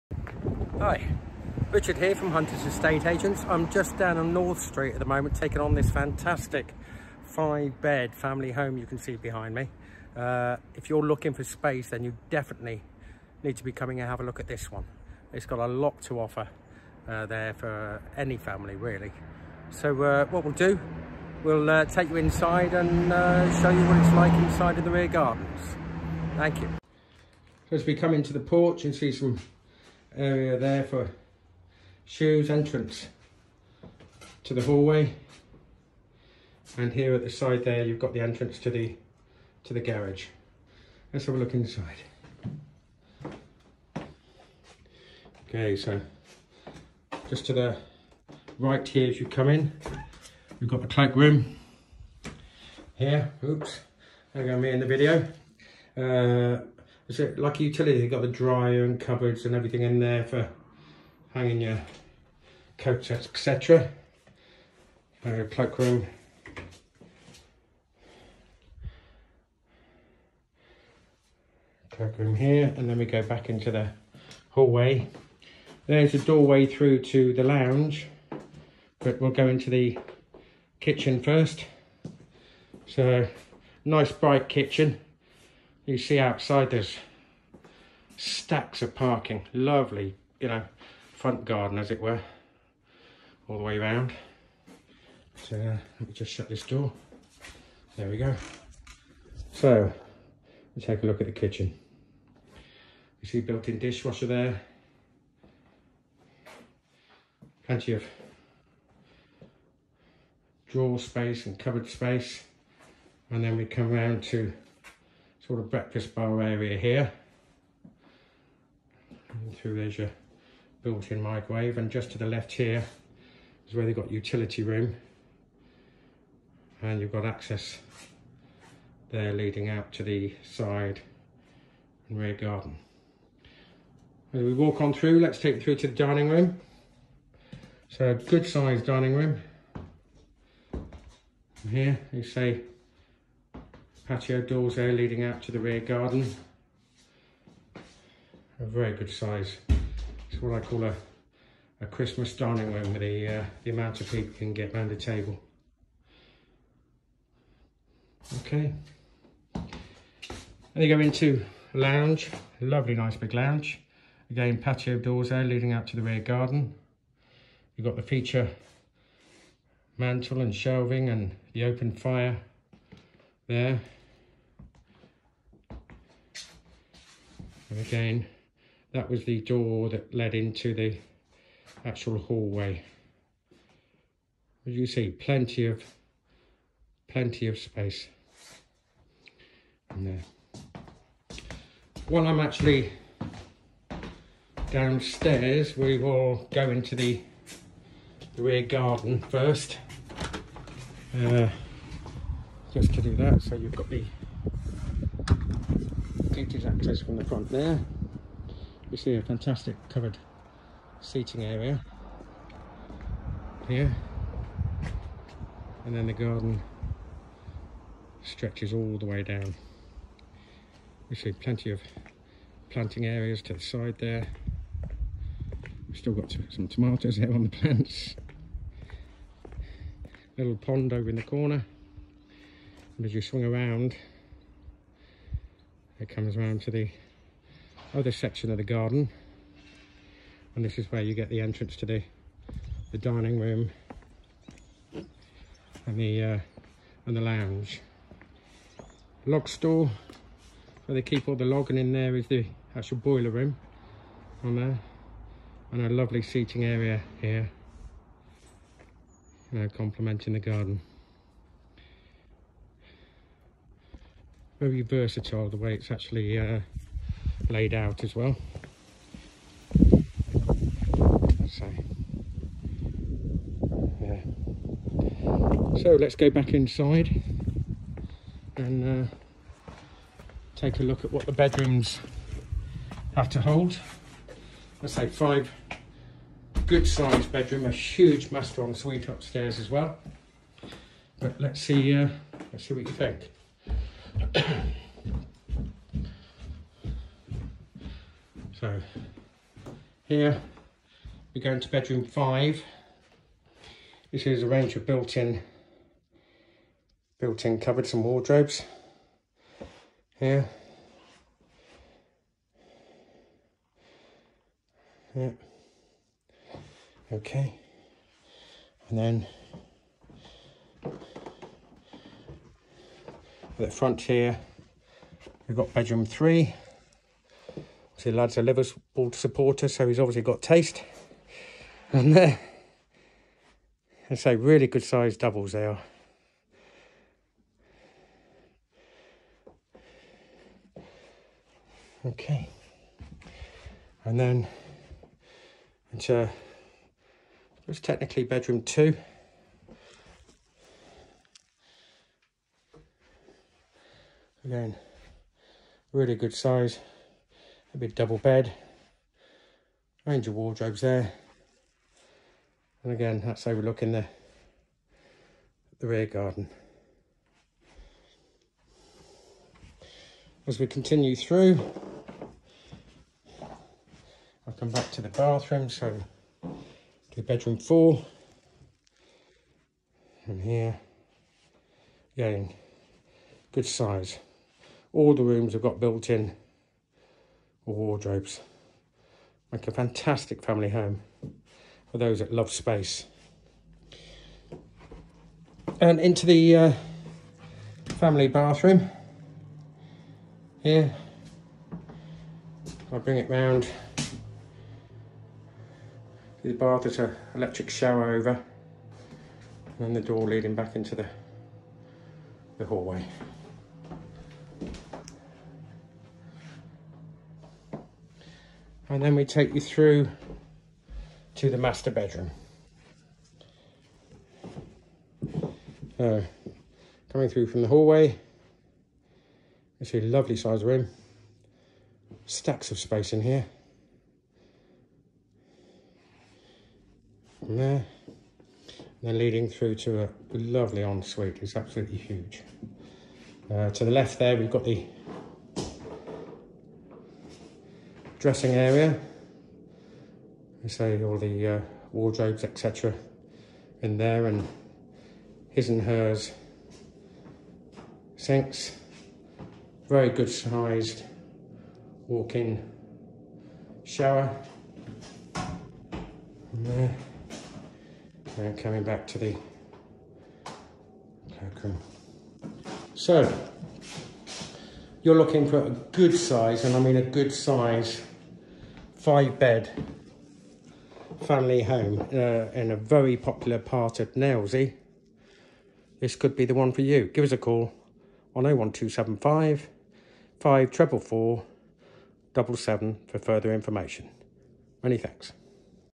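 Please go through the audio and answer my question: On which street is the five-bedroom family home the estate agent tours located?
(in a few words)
North Street.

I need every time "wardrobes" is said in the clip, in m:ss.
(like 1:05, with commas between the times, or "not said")
5:08, 6:00, 6:27, 7:31.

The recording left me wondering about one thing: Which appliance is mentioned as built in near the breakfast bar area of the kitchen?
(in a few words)
Microwave.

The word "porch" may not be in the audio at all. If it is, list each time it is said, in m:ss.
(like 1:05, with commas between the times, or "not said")
0:28.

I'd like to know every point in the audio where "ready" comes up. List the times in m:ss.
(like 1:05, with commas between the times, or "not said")
not said.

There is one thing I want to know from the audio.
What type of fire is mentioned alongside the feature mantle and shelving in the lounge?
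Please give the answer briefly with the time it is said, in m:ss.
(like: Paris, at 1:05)
Open fire, at 2:51.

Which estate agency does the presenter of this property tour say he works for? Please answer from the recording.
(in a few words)
Hunters.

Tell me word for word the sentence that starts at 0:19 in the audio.
So uh, what we'll do, we'll uh, take you inside and uh, show you what it's like inside of the rear gardens.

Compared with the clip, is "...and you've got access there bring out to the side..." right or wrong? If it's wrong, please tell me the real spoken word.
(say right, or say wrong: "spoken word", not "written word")
wrong: "leading", not "bring".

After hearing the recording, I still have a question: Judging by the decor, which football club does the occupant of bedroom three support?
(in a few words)
Liverpool.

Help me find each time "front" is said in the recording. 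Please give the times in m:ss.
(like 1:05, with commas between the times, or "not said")
1:31, 3:27, 5:23.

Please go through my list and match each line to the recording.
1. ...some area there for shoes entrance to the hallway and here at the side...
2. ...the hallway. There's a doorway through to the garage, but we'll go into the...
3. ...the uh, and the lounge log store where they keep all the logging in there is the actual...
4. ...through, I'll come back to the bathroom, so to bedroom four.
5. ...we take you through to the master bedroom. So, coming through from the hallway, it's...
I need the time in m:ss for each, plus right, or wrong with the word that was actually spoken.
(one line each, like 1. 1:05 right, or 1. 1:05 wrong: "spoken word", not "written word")
1. 0:29 right
2. 1:13 wrong: "lounge", not "garage"
3. 4:05 right
4. 6:11 right
5. 6:59 right.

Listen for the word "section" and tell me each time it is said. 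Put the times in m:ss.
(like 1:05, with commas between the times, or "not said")
3:58.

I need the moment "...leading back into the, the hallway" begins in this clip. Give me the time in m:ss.
6:50.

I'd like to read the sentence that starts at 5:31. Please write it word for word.
And there, I say, really good sized doubles they are.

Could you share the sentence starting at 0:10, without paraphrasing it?
Uh, if you're looking for space then you definitely need to be coming and have a look at this one.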